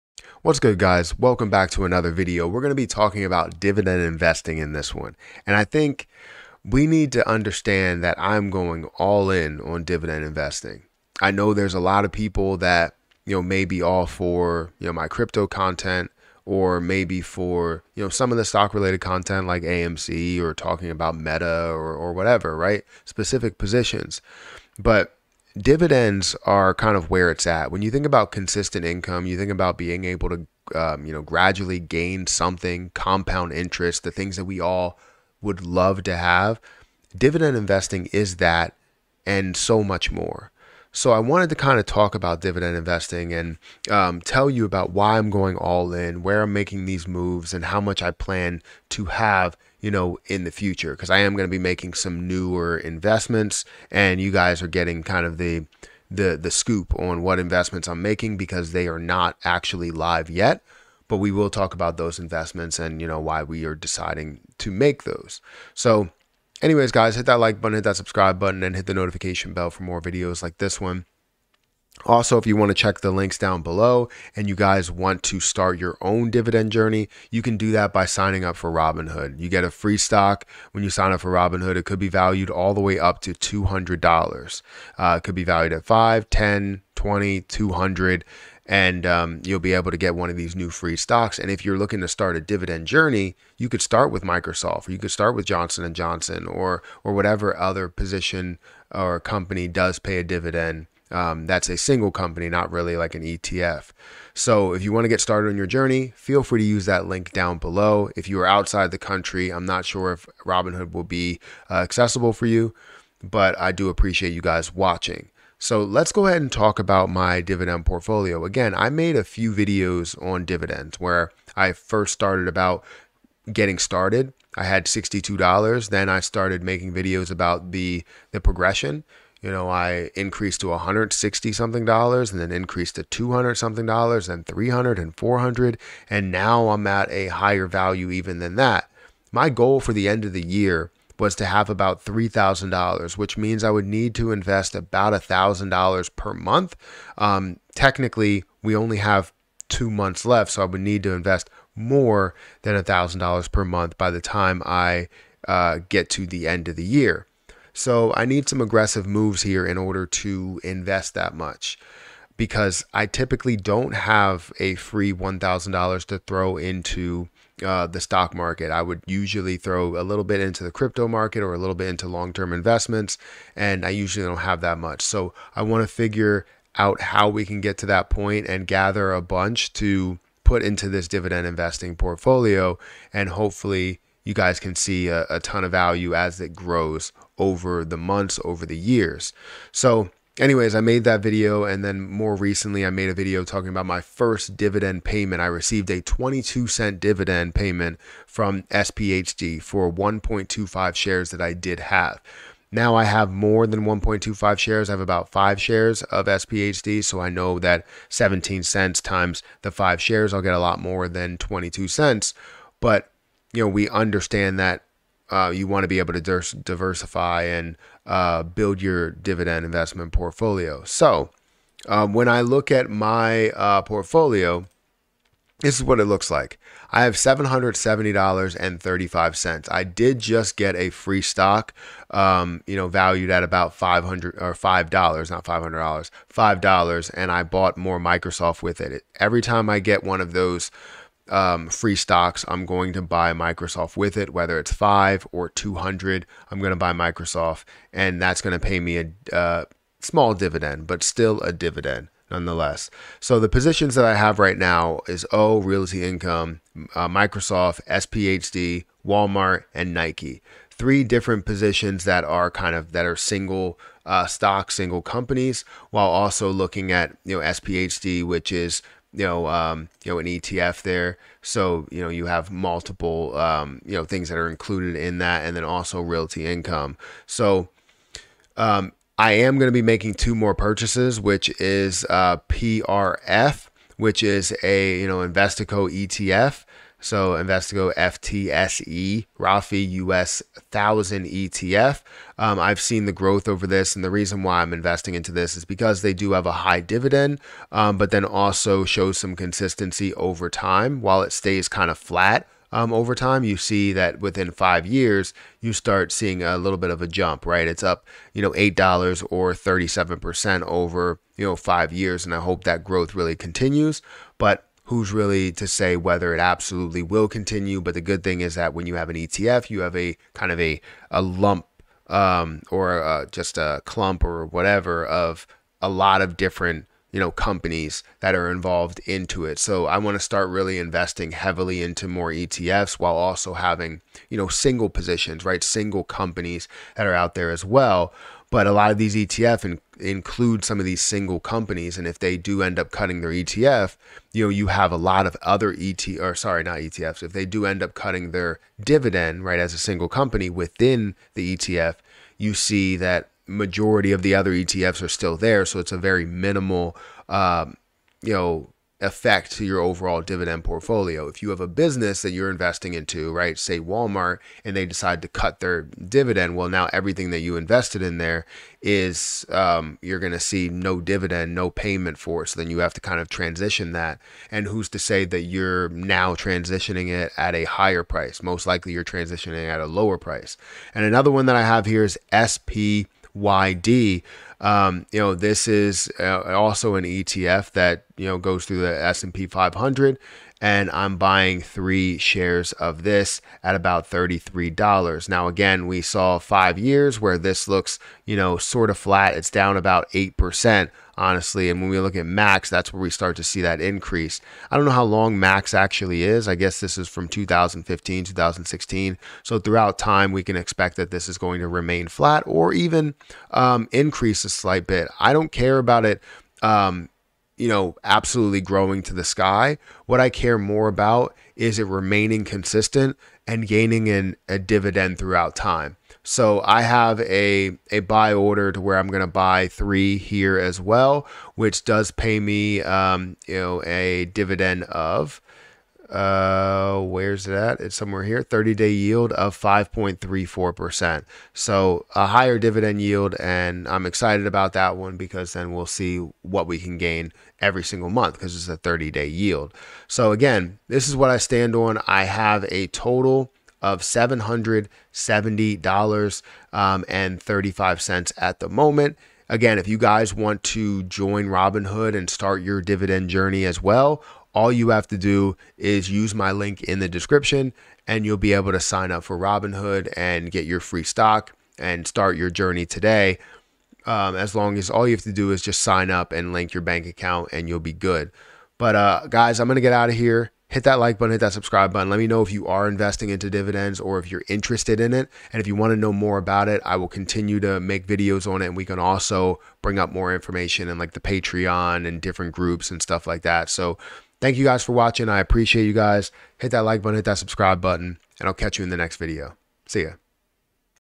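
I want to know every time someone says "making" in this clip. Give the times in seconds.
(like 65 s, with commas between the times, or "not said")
46 s, 51 s, 58 s, 126 s, 279 s.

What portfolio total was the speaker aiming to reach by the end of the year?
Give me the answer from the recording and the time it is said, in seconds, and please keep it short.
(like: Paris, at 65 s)
$3,000, at 142 s.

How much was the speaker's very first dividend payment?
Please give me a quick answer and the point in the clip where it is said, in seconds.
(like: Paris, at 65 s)
22 cents, at 196 s.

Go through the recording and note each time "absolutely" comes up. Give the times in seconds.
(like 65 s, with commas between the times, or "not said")
316 s, 418 s.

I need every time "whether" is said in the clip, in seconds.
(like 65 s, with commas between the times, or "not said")
244 s, 315 s.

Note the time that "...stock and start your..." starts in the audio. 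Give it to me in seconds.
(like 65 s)
471 s.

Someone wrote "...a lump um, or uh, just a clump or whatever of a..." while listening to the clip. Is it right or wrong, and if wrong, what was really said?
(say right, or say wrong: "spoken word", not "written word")
right.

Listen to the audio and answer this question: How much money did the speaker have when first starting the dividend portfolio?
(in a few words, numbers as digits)
$62.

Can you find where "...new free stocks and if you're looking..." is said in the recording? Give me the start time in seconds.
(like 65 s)
90 s.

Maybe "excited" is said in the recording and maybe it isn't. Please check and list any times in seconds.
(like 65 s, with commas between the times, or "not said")
444 s.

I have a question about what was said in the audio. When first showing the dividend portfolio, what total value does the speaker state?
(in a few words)
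$770.35.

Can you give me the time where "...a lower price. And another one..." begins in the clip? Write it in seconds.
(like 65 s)
379 s.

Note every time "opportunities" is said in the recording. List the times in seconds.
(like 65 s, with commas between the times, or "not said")
not said.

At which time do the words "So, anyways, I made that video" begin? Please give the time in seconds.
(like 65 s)
189 s.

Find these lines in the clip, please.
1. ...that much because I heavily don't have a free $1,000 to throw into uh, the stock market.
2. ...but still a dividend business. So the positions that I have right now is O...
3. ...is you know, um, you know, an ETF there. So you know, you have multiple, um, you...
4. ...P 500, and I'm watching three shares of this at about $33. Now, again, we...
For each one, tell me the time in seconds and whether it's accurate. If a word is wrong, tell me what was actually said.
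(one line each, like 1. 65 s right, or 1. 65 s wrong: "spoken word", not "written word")
1. 161 s wrong: "typically", not "heavily"
2. 250 s wrong: "nonetheless", not "business"
3. 268 s right
4. 389 s wrong: "buying", not "watching".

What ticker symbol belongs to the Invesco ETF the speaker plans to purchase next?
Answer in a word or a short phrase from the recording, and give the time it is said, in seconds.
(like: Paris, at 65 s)
PRF, at 282 s.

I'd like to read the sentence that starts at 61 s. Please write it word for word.
But we will talk about those investments and you know why we are deciding to make those.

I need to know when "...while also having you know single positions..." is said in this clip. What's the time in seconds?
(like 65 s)
332 s.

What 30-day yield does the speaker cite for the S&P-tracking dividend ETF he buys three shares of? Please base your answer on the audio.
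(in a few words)
5.34%.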